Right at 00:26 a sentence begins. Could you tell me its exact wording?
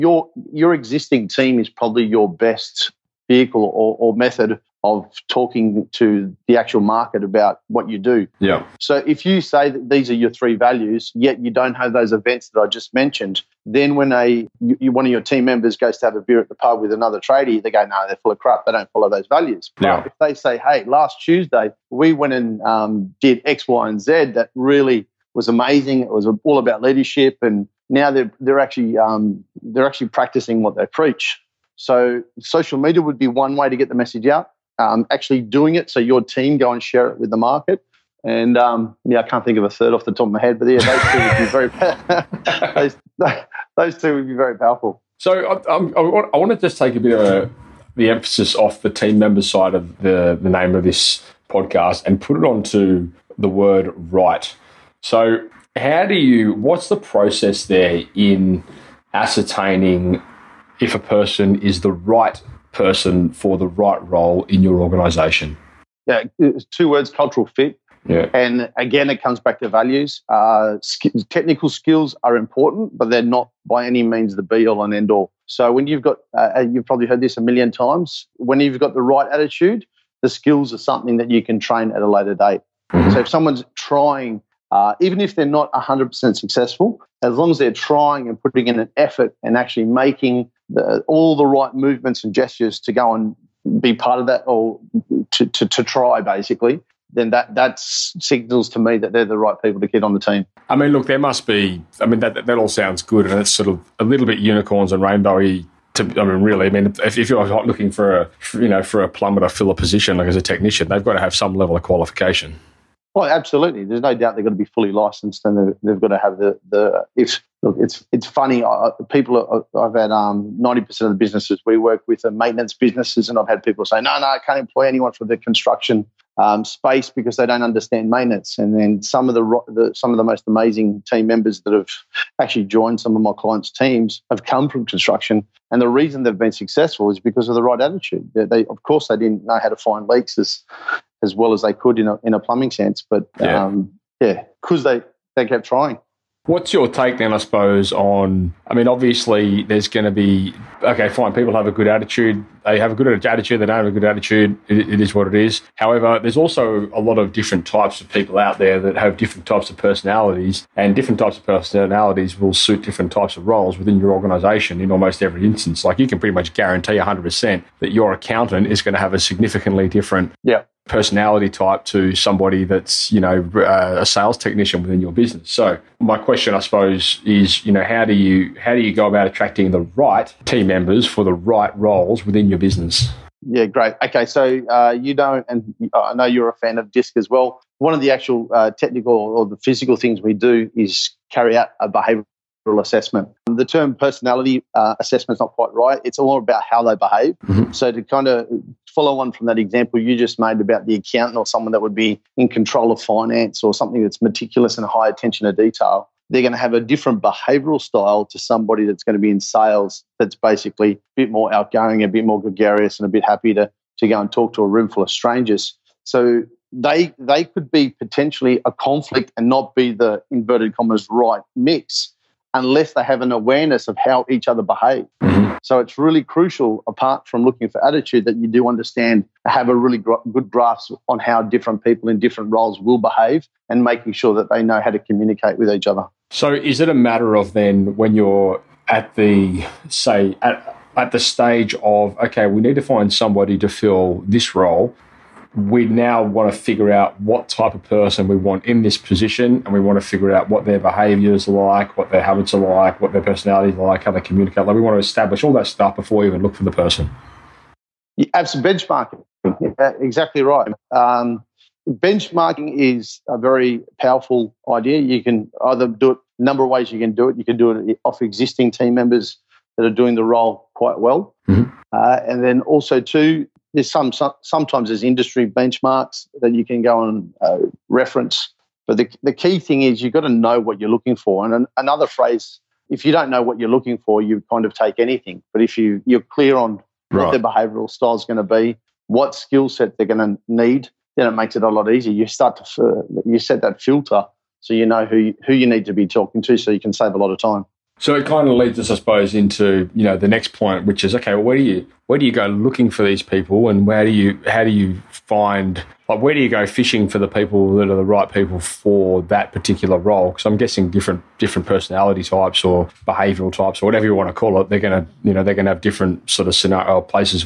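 It was all about leadership and now they're they're actually um, they're actually practicing what they preach.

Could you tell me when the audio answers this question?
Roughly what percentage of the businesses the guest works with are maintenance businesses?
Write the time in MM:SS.
02:00.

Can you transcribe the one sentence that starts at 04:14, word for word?
Like we want to establish all that stuff before we even look for the person.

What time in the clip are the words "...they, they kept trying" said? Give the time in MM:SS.
02:24.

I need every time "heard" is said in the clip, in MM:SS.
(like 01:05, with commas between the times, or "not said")
01:17.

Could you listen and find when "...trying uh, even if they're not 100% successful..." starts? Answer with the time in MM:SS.
01:23.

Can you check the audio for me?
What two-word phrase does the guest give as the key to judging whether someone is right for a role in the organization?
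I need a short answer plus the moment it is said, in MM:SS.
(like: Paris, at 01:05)
cultural fit, at 01:07.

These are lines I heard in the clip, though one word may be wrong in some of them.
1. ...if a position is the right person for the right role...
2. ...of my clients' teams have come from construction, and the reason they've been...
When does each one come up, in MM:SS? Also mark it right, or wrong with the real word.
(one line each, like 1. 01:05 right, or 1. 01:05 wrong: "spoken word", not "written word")
1. 01:00 wrong: "person", not "position"
2. 02:13 right.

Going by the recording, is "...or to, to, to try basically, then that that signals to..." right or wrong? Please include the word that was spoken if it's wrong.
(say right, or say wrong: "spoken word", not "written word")
right.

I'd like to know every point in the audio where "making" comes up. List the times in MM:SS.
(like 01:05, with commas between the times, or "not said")
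01:29, 03:53.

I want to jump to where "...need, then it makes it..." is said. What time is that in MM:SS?
04:50.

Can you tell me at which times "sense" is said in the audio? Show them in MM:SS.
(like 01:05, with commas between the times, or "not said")
02:22.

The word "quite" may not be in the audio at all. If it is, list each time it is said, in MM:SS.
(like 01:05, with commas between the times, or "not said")
03:15, 04:30.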